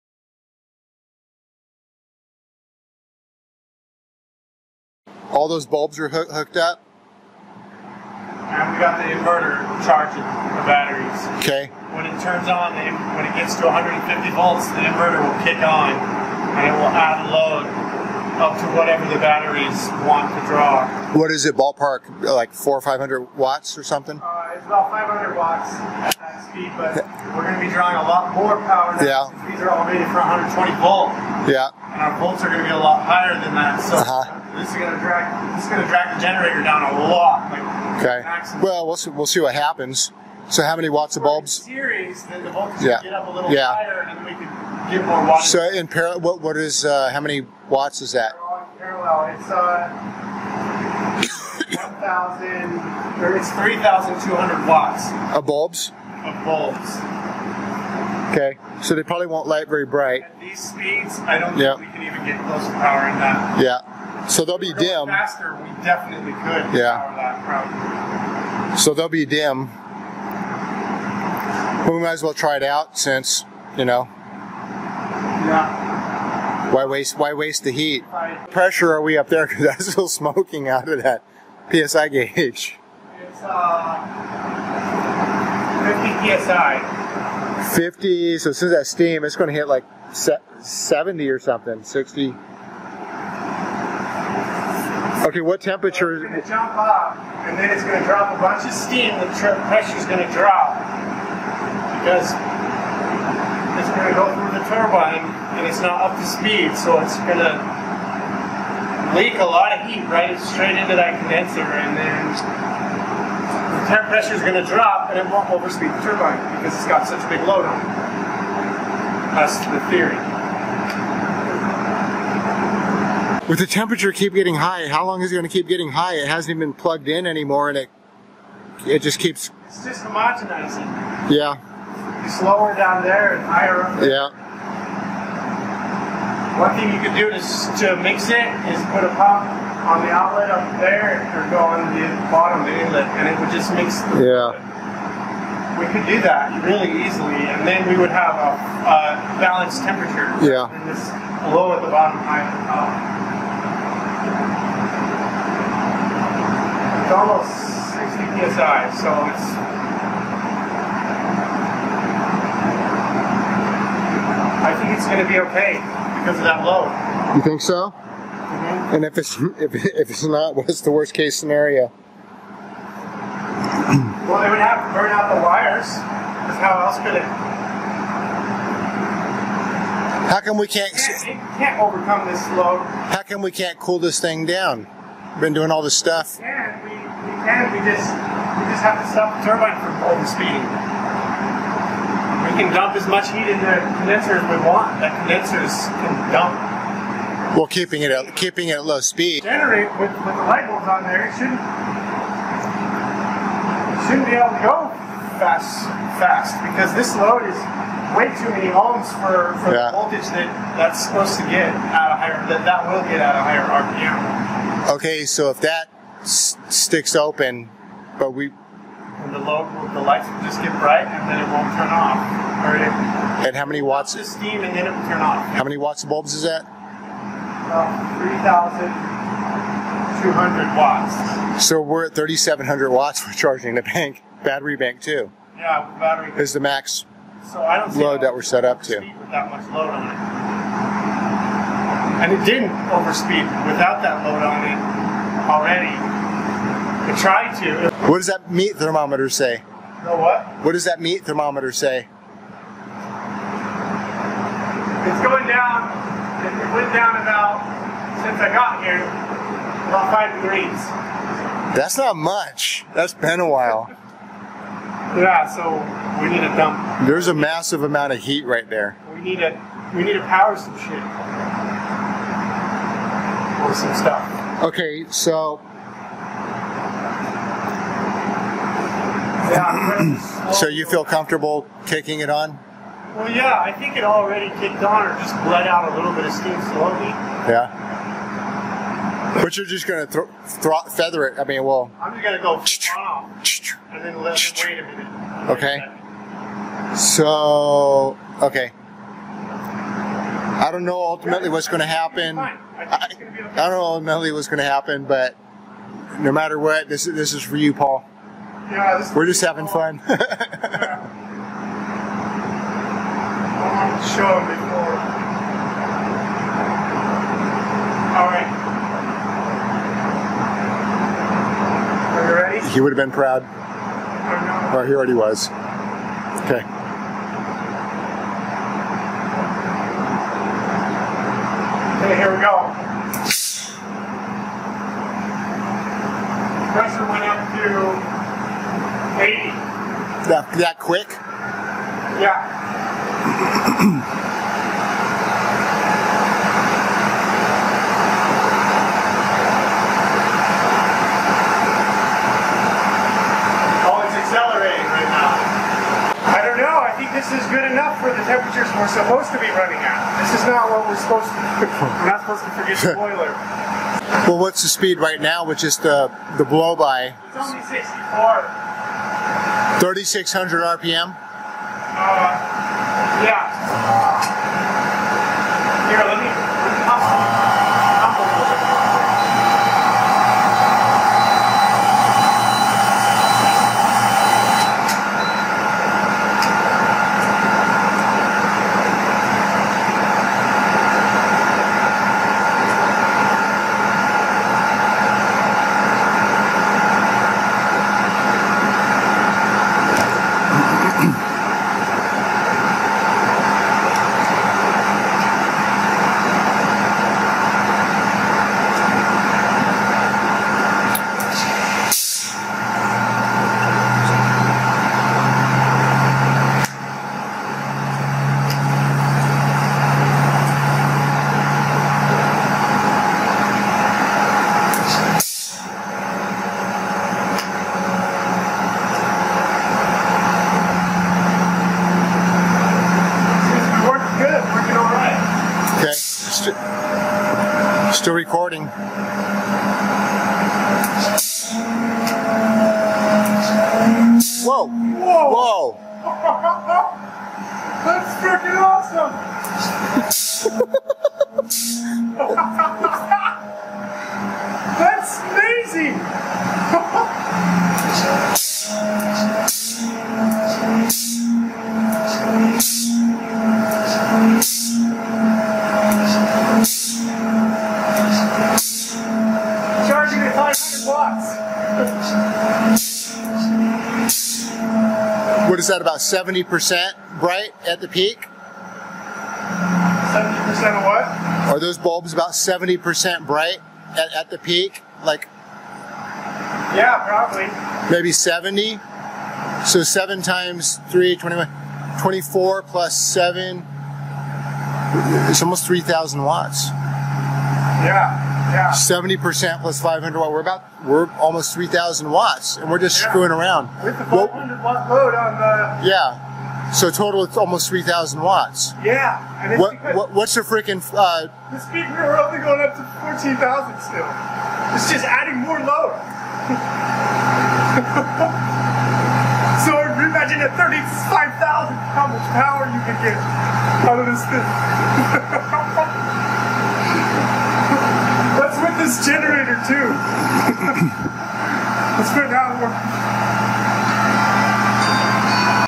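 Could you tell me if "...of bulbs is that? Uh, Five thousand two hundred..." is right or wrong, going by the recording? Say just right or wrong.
wrong.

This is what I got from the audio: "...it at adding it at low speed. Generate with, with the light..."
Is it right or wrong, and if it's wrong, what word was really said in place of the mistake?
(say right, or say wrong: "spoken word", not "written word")
wrong: "keeping", not "adding".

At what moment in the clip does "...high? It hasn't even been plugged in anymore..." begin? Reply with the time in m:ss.
2:05.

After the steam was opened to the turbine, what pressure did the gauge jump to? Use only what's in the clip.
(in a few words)
80.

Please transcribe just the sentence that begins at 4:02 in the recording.
And it didn't overspeed without that load on it already.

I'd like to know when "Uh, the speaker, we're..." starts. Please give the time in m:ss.
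8:30.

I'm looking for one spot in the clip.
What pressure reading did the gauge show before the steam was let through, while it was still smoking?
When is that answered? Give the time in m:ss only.
1:23.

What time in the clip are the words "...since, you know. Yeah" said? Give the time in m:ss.
1:12.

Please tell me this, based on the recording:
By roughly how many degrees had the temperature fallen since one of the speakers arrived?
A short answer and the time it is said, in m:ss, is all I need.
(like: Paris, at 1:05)
5 degrees, at 4:19.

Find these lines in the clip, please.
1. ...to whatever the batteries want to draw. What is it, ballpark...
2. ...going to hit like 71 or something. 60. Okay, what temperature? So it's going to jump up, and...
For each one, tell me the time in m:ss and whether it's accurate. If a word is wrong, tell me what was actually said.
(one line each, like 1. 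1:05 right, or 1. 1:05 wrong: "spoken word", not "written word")
1. 0:18 right
2. 1:29 wrong: "70", not "71".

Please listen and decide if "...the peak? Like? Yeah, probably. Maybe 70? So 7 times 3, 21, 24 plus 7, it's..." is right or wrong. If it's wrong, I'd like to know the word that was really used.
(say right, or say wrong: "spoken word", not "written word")
right.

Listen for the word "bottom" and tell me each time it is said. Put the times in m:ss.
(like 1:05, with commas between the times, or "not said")
2:22, 2:31.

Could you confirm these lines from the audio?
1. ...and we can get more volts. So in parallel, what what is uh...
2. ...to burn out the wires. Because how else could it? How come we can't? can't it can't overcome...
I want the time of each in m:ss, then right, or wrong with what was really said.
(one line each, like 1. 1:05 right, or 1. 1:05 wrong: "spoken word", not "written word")
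1. 0:44 wrong: "watts", not "volts"
2. 2:54 right.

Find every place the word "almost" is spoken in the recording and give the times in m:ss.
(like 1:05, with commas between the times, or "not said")
2:37, 8:15, 8:21, 8:27.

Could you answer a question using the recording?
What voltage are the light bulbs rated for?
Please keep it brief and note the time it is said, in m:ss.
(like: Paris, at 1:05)
120 volts, at 0:30.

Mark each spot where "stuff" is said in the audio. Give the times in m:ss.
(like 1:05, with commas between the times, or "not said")
3:05, 4:33.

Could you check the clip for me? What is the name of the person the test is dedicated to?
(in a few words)
Paul.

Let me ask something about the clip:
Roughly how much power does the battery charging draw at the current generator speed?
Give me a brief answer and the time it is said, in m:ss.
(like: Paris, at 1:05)
500 watts, at 0:24.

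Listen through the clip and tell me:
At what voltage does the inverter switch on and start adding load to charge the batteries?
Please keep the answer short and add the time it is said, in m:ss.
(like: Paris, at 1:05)
150 volts, at 0:13.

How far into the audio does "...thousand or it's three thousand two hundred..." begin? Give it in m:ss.
0:52.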